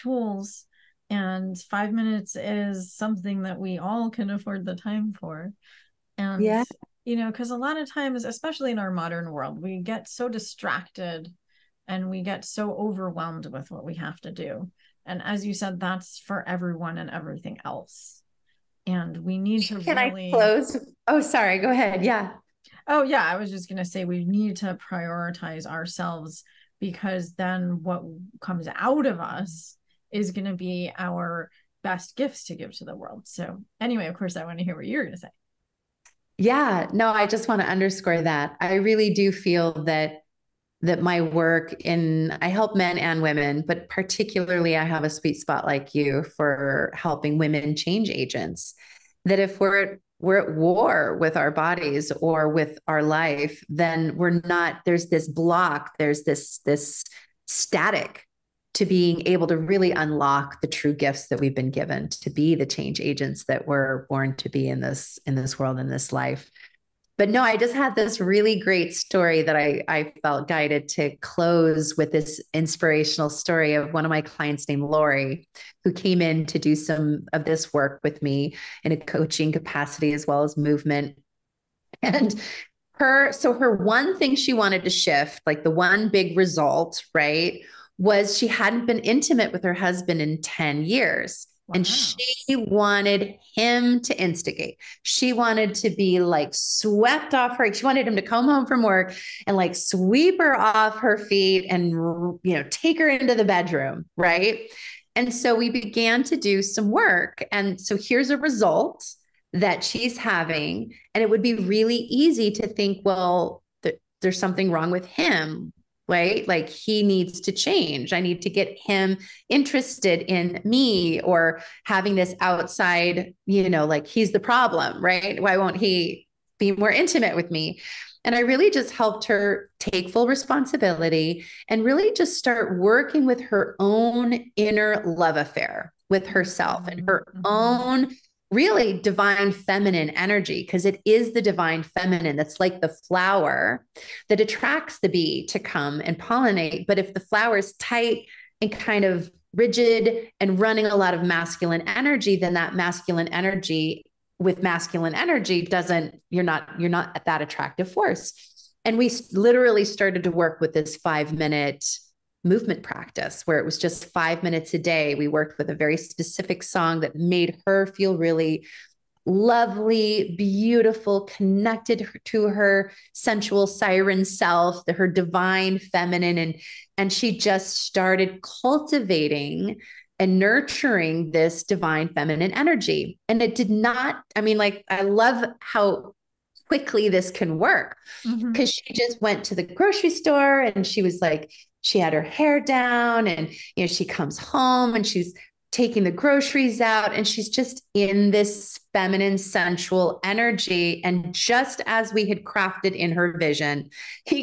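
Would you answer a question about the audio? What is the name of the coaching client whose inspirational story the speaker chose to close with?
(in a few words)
Lori.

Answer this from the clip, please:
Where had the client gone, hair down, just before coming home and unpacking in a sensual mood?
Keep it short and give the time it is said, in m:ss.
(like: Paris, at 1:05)
grocery store, at 3:09.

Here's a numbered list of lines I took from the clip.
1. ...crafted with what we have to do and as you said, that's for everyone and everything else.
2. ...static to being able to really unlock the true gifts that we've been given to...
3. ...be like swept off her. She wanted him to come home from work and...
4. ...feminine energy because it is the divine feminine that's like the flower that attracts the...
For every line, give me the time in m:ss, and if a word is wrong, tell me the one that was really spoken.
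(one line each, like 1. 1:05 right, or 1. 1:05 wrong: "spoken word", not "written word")
1. 0:12 wrong: "overwhelmed", not "crafted"
2. 0:57 right
3. 1:35 right
4. 2:19 right.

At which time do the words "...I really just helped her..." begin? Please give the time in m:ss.
2:08.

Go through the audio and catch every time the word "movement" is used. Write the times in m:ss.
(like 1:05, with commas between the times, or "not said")
1:20, 2:42.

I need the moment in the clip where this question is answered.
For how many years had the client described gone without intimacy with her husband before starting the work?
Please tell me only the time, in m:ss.
1:30.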